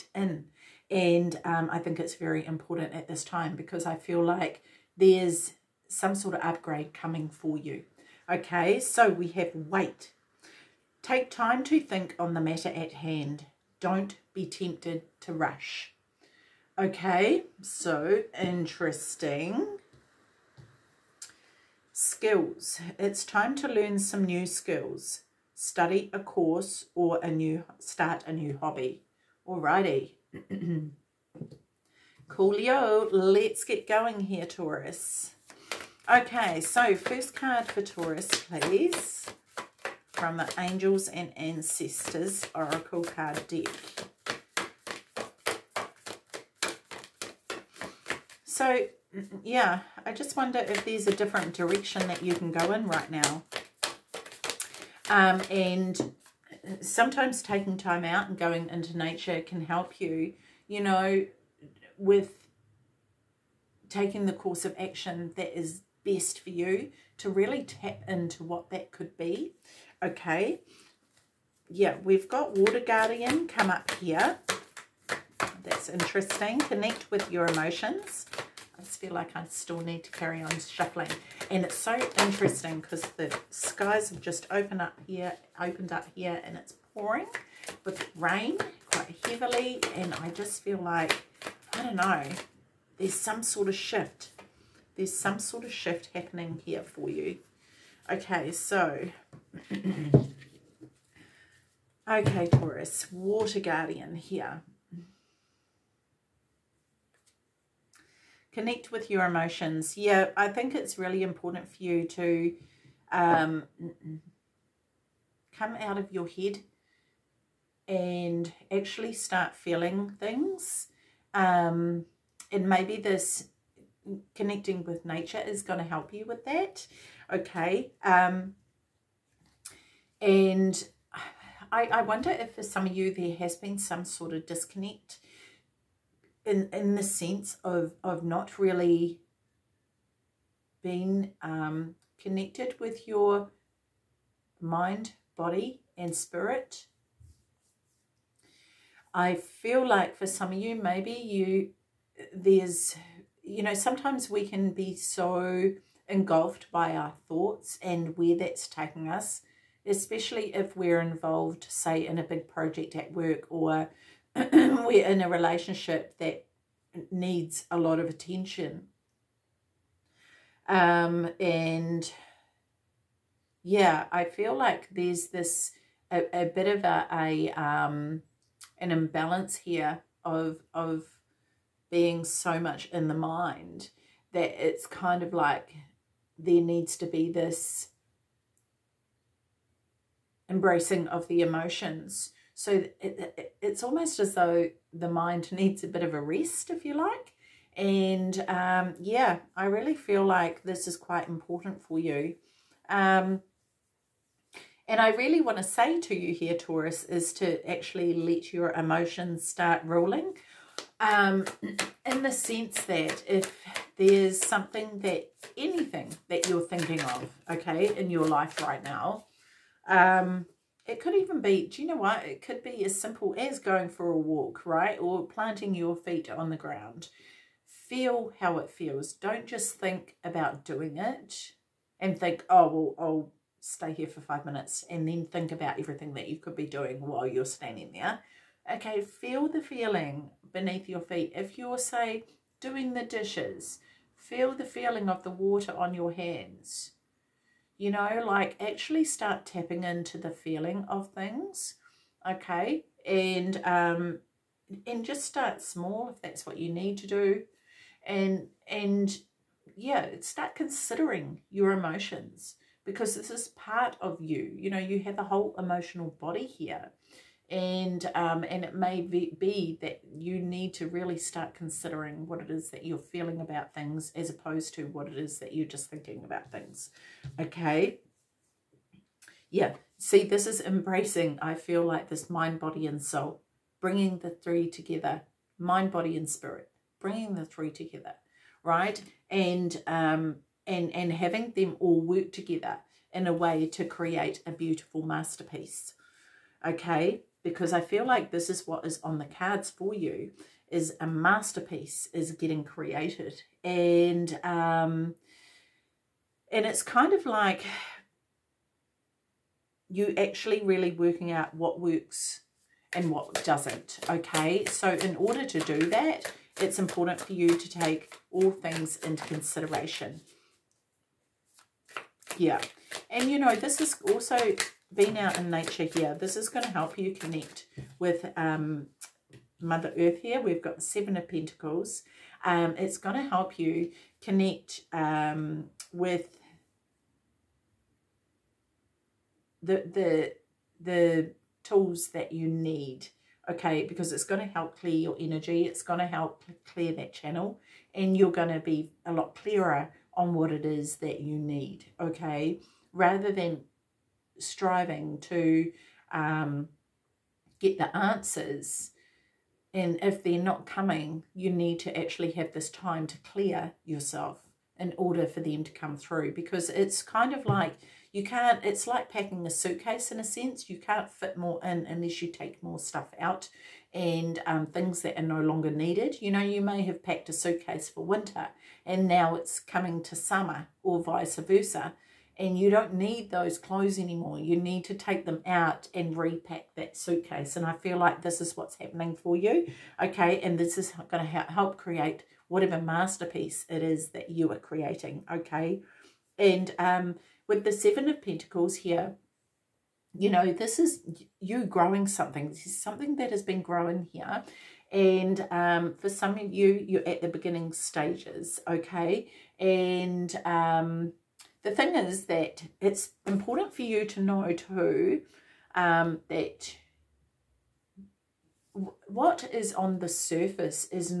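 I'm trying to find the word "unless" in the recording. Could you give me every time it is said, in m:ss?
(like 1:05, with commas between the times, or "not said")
6:11.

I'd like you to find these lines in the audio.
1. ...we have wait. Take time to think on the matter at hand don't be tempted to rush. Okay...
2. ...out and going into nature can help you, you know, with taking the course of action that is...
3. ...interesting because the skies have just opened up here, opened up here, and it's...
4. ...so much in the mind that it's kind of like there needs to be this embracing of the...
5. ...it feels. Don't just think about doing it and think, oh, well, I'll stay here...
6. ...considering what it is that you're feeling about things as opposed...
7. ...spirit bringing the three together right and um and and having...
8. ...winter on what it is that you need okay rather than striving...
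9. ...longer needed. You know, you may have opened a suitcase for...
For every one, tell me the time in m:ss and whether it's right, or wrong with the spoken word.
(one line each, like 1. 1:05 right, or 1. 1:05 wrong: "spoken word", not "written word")
1. 0:09 right
2. 0:58 right
3. 1:22 right
4. 3:02 right
5. 3:48 right
6. 4:31 right
7. 4:46 right
8. 5:49 wrong: "clearer", not "winter"
9. 6:15 wrong: "packed", not "opened".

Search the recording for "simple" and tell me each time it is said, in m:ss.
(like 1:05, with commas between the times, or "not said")
3:42.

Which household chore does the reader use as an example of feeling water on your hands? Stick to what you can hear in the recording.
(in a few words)
Doing the dishes.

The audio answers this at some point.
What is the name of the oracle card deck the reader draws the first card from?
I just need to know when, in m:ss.
0:40.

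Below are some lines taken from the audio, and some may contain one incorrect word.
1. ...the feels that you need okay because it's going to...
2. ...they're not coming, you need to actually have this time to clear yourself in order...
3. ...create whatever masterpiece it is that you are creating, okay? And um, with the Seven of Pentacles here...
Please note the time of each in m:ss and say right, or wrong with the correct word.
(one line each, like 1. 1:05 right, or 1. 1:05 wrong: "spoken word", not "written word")
1. 5:40 wrong: "tools", not "feels"
2. 6:00 right
3. 6:31 right.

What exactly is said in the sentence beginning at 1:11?
Yeah, we've got water guardian come up here.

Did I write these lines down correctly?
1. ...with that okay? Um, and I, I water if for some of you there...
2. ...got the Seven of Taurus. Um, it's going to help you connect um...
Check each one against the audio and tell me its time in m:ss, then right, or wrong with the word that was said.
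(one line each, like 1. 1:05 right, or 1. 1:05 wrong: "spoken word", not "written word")
1. 2:06 wrong: "wonder", not "water"
2. 5:30 wrong: "Pentacles", not "Taurus".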